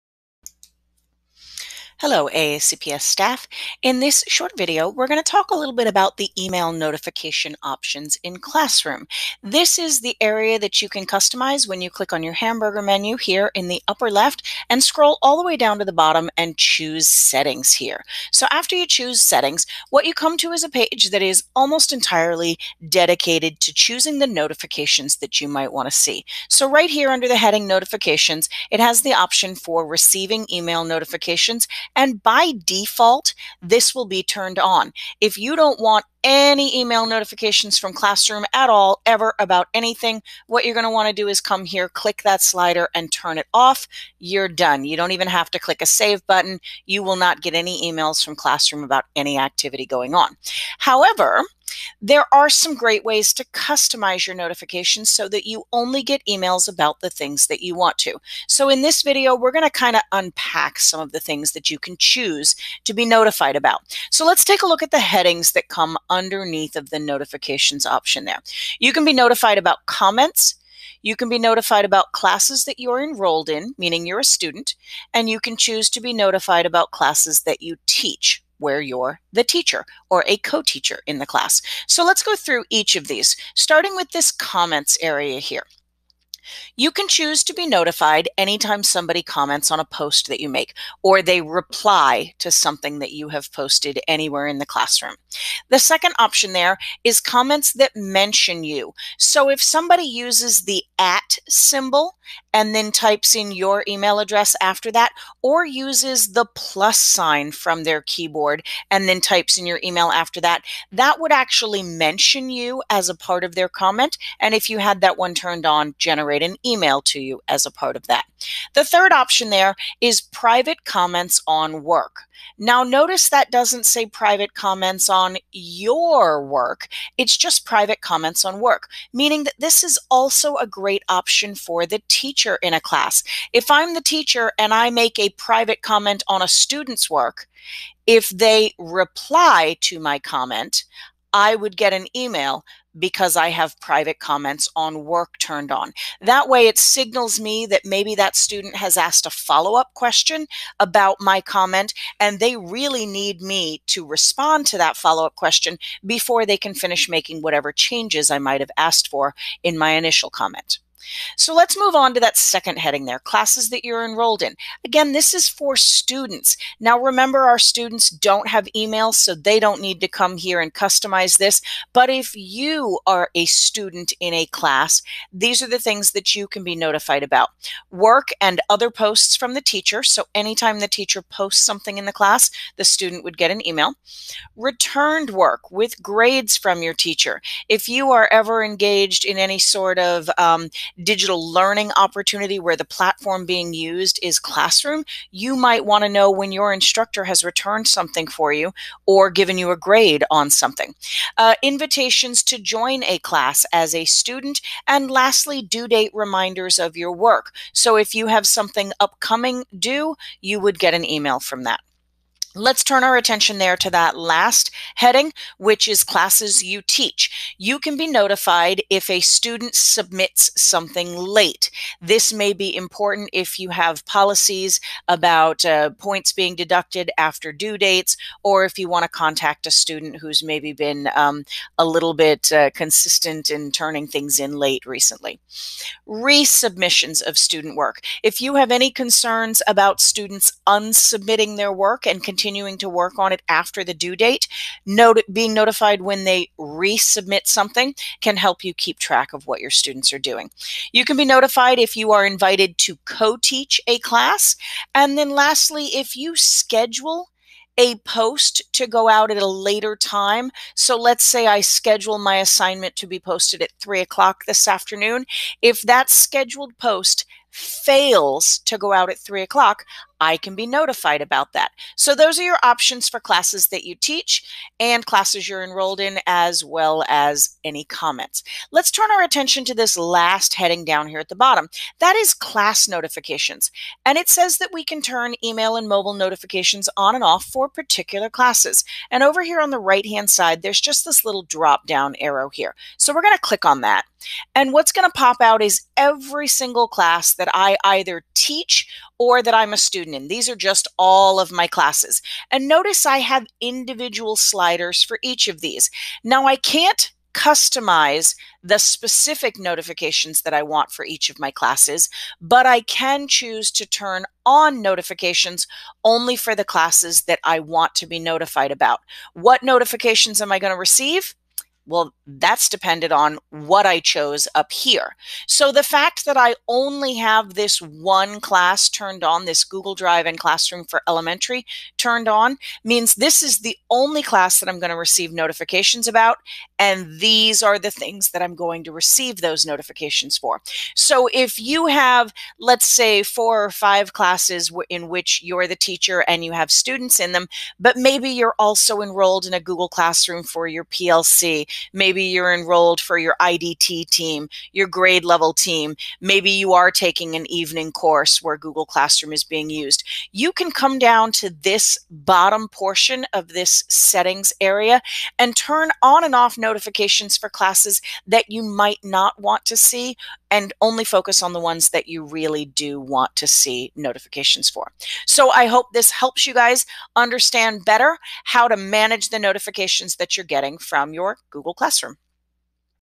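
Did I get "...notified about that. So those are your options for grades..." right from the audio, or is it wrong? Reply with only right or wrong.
wrong.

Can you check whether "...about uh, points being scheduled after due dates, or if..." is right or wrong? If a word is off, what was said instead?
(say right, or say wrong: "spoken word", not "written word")
wrong: "deducted", not "scheduled".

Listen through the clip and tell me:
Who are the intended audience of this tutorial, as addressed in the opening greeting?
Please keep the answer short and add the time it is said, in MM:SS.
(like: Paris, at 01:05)
AACPS staff, at 00:02.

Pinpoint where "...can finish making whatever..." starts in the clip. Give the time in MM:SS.
02:36.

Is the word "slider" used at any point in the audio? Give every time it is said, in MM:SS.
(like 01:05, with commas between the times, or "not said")
00:42, 05:04.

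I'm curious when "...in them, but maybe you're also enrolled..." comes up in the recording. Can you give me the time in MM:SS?
05:47.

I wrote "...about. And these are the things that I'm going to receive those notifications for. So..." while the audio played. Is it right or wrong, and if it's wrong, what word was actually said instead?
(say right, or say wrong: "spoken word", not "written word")
right.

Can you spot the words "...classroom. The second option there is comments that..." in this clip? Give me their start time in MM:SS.
01:34.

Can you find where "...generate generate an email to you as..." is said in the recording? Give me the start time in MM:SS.
01:55.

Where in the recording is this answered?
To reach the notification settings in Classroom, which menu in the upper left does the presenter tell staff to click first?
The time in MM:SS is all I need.
00:12.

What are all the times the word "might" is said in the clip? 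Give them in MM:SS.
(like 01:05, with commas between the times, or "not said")
00:25, 02:38, 03:15, 06:08.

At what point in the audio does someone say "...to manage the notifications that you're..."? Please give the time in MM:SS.
06:18.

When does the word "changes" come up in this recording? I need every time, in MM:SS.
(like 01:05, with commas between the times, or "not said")
02:37.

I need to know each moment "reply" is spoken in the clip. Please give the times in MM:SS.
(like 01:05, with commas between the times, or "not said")
01:31, 02:18.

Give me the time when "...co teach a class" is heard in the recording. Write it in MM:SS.
04:13.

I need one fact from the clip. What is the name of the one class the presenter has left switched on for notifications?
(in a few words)
Google Drive and Classroom for Elementary.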